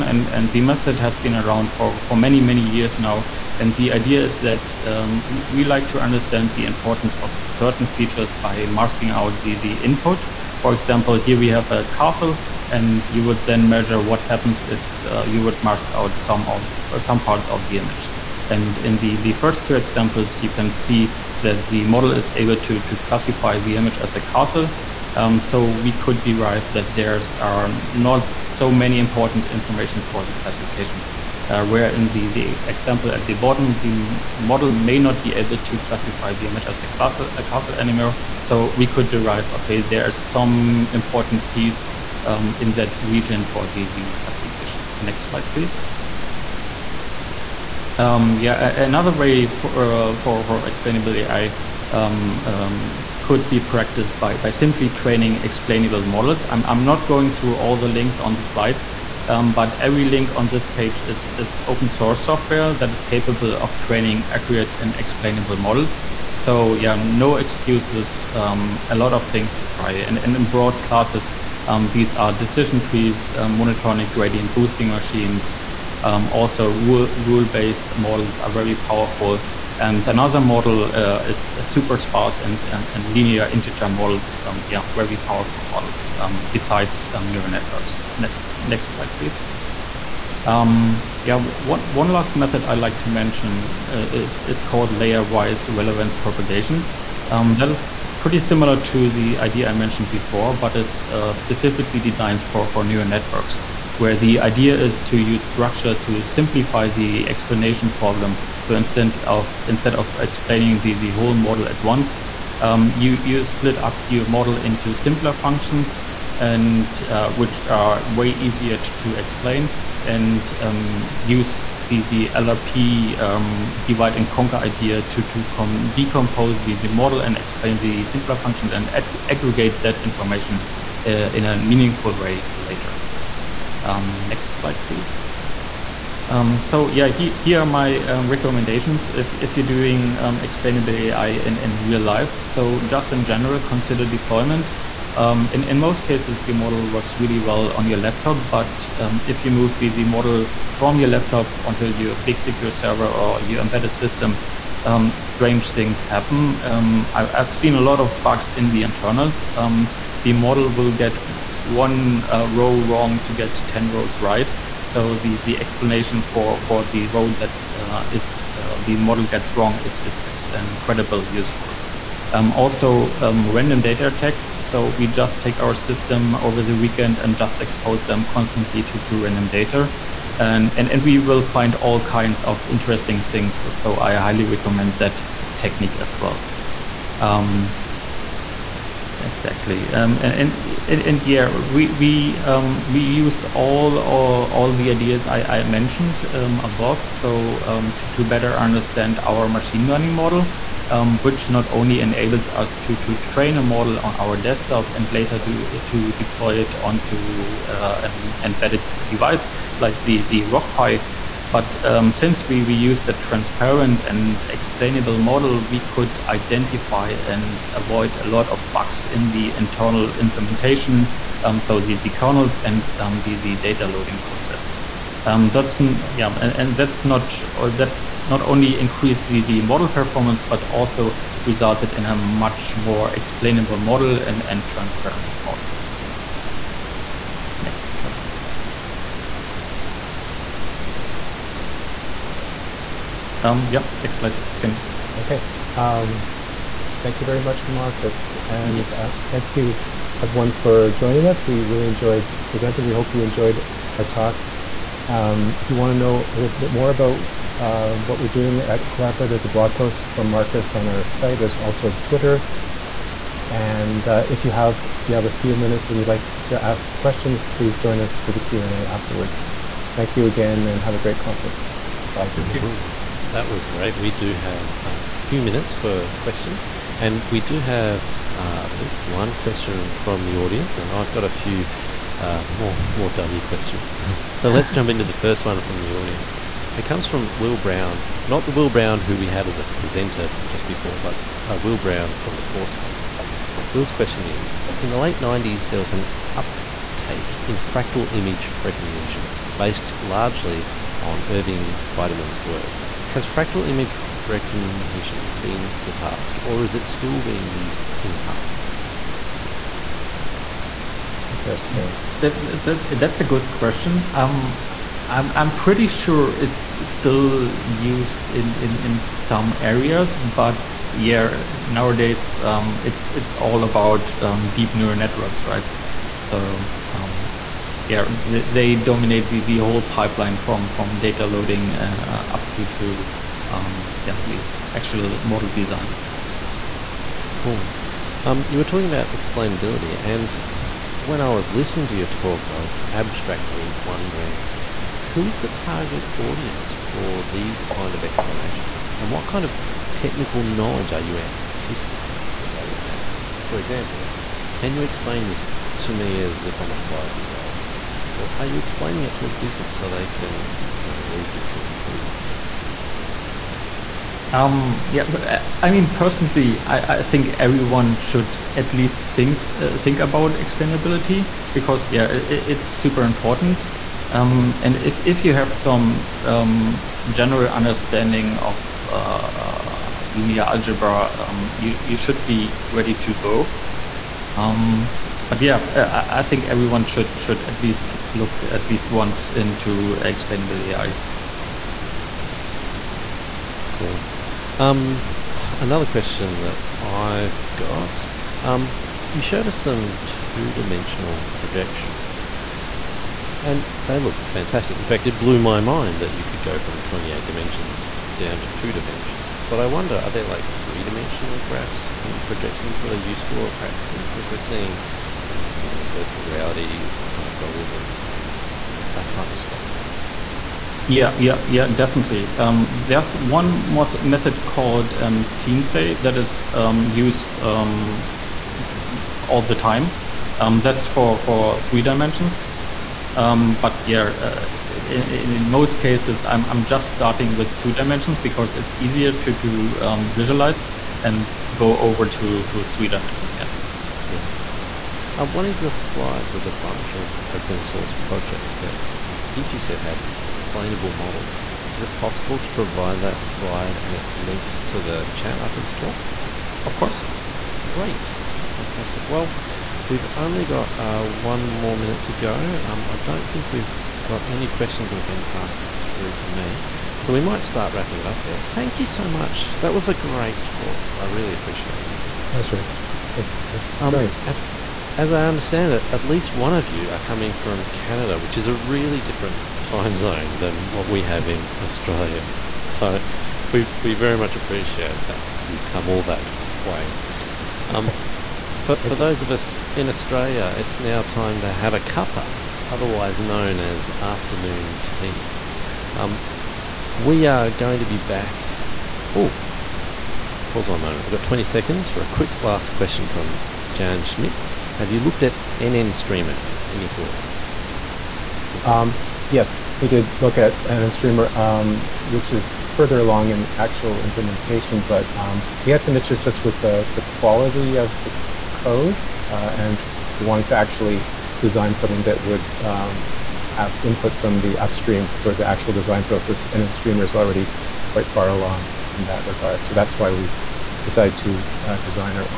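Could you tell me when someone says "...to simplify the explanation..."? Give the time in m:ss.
1:45.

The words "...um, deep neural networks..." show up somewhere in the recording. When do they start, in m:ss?
5:24.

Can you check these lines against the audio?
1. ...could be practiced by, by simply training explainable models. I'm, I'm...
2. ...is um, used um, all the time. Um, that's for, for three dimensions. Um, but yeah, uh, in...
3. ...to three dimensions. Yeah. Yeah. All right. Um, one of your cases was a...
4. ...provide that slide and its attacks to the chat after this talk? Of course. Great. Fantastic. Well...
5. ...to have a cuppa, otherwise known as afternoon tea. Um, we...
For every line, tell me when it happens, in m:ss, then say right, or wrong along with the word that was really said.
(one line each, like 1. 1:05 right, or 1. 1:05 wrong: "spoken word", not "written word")
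1. 0:53 right
2. 7:06 right
3. 7:22 wrong: "slides", not "cases"
4. 7:32 wrong: "links", not "attacks"
5. 8:11 right.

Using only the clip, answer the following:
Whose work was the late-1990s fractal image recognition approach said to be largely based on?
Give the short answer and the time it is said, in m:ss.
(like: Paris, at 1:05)
Irving Biederman, at 5:01.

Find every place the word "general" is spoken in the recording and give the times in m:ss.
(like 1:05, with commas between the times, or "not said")
2:23, 6:17.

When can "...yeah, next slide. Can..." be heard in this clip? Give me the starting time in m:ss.
4:03.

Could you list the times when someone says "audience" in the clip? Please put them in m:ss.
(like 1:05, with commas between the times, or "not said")
4:40, 4:45, 5:46.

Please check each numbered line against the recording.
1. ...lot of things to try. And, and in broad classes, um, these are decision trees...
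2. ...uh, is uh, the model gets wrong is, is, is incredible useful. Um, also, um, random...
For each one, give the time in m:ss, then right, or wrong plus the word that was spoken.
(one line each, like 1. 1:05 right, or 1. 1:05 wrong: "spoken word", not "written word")
1. 1:08 right
2. 2:47 right.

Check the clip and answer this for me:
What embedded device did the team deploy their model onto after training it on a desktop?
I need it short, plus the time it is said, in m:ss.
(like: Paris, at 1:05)
Rock Pi, at 3:30.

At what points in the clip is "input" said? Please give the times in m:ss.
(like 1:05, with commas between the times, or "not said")
0:09, 8:43.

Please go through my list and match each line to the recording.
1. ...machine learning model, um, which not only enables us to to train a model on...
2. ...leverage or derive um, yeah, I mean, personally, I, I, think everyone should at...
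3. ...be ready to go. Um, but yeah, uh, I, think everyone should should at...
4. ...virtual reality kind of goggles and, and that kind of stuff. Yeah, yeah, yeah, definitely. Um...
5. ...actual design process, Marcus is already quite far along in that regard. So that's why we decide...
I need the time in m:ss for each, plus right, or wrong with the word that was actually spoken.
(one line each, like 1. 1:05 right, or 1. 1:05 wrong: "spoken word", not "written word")
1. 3:19 right
2. 6:01 wrong: "improve", not "derive"
3. 6:22 right
4. 6:55 right
5. 8:45 wrong: "NNStreamer", not "Marcus".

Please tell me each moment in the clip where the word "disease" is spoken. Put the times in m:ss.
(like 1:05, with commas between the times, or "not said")
not said.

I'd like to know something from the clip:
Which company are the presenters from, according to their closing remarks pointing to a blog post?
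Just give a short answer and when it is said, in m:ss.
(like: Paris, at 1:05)
Collabora, at 4:18.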